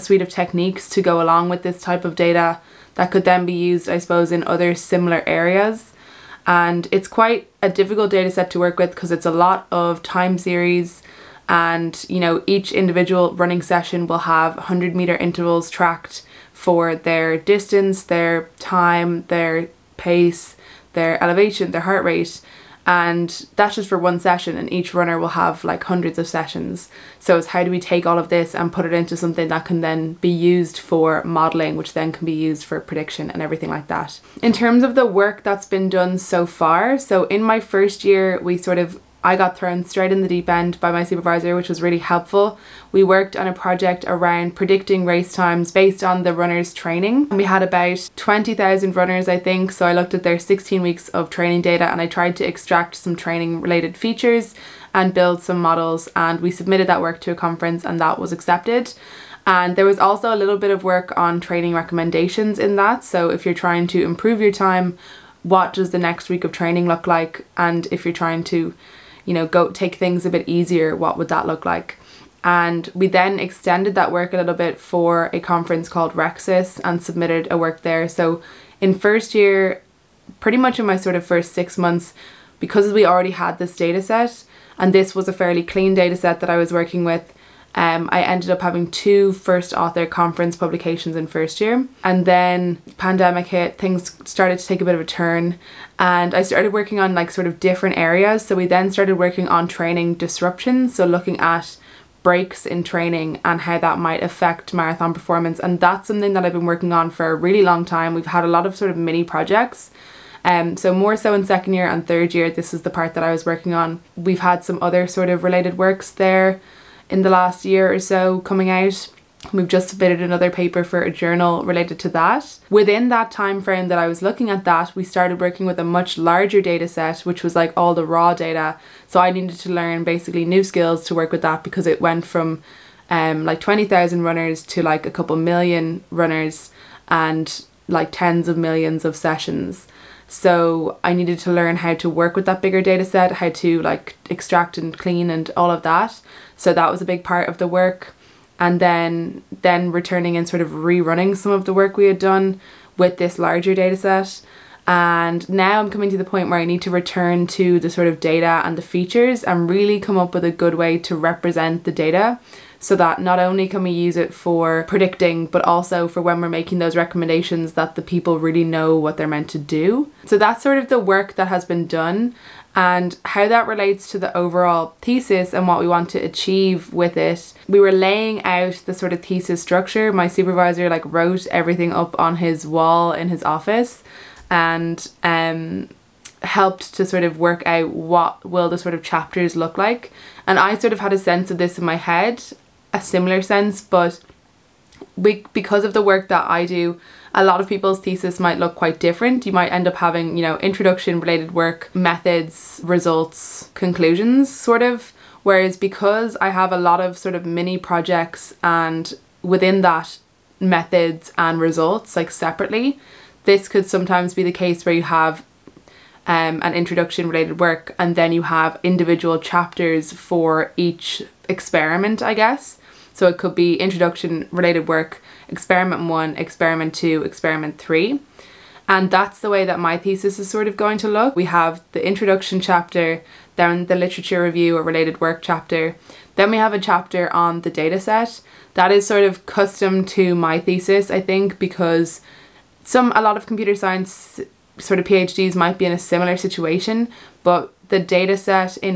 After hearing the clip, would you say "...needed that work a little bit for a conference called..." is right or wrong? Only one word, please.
wrong.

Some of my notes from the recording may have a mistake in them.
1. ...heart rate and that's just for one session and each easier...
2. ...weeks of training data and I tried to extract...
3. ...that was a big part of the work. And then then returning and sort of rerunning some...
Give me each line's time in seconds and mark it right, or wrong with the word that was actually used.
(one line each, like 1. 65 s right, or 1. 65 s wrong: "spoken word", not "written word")
1. 21 s wrong: "runner", not "easier"
2. 50 s right
3. 146 s right.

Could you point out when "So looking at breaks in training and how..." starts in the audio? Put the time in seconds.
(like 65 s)
100 s.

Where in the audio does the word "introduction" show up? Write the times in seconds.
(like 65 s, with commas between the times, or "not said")
200 s, 216 s, 223 s, 232 s.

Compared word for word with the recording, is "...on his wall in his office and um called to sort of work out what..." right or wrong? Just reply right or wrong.
wrong.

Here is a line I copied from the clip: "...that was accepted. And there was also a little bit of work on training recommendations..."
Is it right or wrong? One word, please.
right.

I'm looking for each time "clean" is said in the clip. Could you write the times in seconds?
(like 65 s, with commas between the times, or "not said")
85 s, 144 s.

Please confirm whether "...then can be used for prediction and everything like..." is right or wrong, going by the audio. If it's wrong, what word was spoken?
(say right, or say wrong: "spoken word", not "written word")
right.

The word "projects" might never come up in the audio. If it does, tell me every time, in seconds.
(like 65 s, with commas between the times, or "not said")
43 s, 109 s, 207 s.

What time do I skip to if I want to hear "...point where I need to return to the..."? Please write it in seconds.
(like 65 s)
156 s.